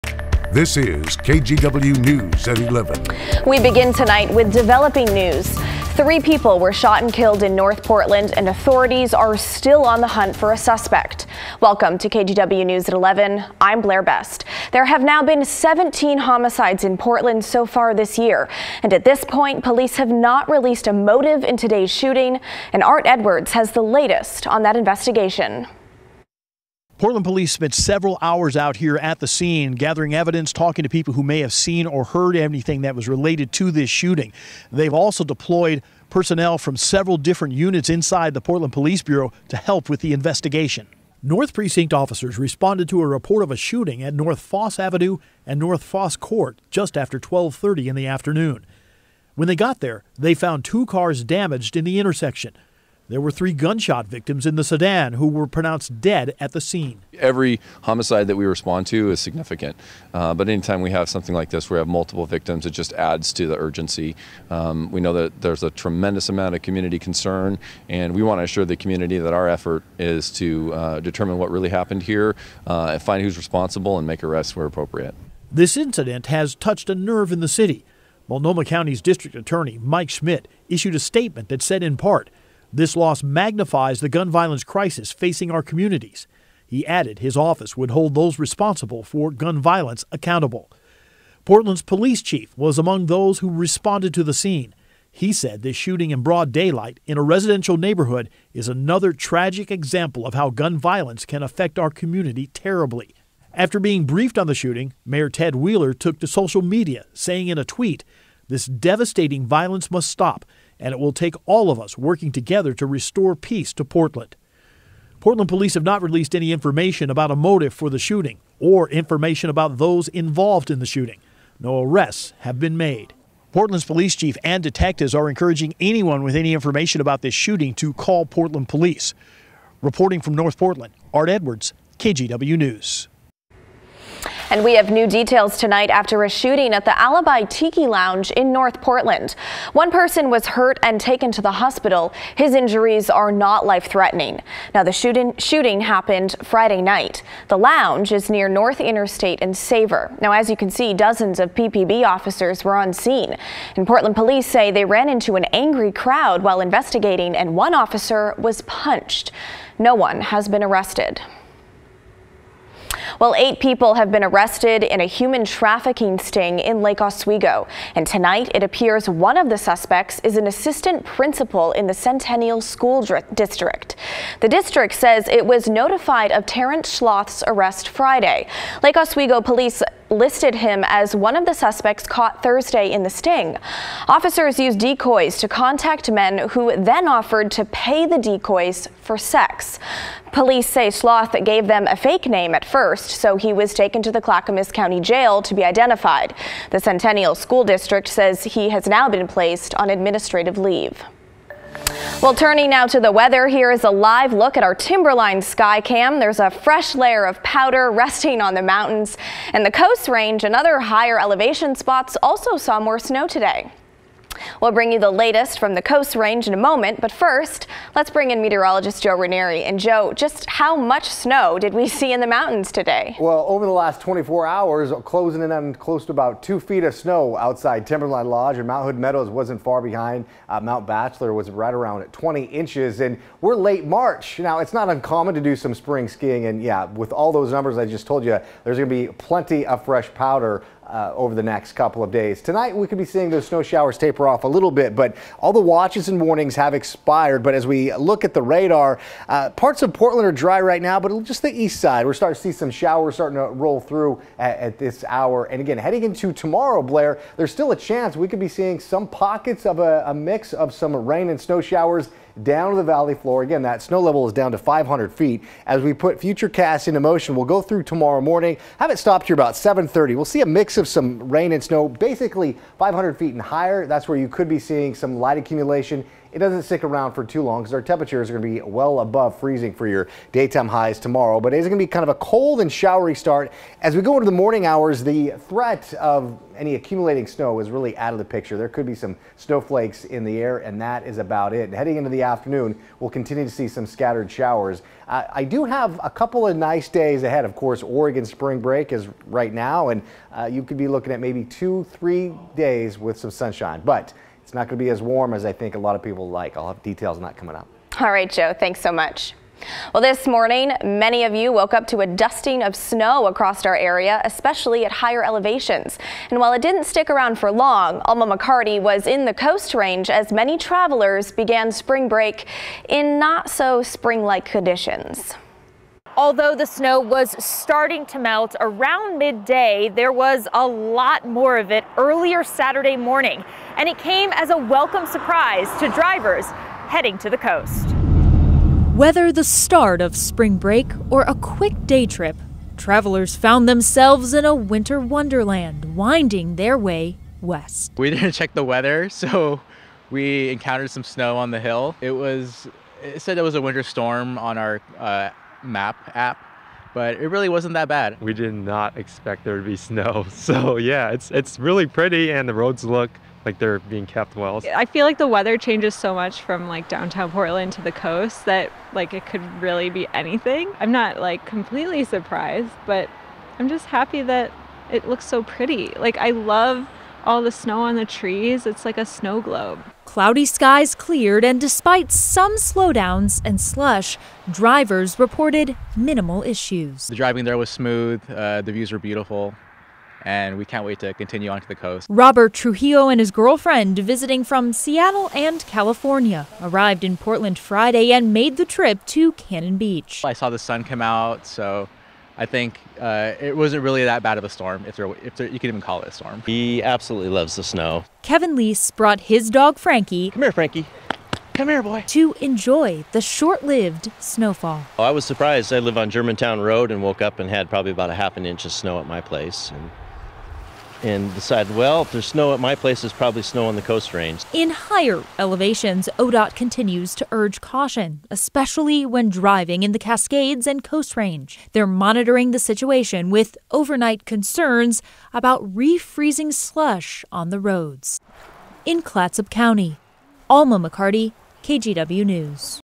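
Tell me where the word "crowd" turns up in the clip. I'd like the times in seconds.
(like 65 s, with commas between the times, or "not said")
155 s.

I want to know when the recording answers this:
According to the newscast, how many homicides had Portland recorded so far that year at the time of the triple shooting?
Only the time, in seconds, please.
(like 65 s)
15 s.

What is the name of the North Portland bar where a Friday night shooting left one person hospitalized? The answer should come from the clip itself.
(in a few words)
Alibi Tiki Lounge.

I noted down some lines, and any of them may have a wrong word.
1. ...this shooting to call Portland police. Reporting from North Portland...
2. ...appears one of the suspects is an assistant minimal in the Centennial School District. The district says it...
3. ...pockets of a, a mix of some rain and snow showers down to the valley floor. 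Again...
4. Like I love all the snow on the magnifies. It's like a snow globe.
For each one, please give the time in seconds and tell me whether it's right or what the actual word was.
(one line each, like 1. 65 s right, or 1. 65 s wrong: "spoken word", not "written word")
1. 127 s right
2. 168 s wrong: "principal", not "minimal"
3. 259 s right
4. 375 s wrong: "trees", not "magnifies".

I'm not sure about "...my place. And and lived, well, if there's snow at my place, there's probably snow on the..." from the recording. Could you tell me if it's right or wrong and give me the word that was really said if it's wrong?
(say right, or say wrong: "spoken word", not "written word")
wrong: "decided", not "lived".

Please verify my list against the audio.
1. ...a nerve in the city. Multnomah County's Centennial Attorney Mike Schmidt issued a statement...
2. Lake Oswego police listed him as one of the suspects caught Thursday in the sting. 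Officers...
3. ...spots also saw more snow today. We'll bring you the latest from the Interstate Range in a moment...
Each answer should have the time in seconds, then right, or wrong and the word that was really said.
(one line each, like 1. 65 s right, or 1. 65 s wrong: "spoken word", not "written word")
1. 76 s wrong: "District", not "Centennial"
2. 178 s right
3. 211 s wrong: "Coast", not "Interstate".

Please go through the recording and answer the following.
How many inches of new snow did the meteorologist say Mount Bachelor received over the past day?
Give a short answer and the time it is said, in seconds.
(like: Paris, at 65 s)
20 inches, at 232 s.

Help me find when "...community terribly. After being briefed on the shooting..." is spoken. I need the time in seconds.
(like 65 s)
101 s.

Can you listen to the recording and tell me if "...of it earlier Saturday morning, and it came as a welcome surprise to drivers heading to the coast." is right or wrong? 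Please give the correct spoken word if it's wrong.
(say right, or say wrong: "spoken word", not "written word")
right.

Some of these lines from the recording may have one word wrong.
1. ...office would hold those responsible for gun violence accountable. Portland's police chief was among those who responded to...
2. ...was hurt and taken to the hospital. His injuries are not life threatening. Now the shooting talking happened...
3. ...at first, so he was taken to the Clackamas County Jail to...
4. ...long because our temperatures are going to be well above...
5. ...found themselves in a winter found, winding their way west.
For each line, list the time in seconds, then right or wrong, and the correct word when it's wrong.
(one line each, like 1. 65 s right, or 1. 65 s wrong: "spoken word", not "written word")
1. 87 s right
2. 140 s wrong: "shooting", not "talking"
3. 192 s right
4. 277 s right
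5. 343 s wrong: "wonderland", not "found".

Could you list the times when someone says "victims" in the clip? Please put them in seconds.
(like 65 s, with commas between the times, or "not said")
54 s, 62 s.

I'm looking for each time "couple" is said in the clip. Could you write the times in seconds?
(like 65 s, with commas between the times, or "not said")
241 s, 296 s.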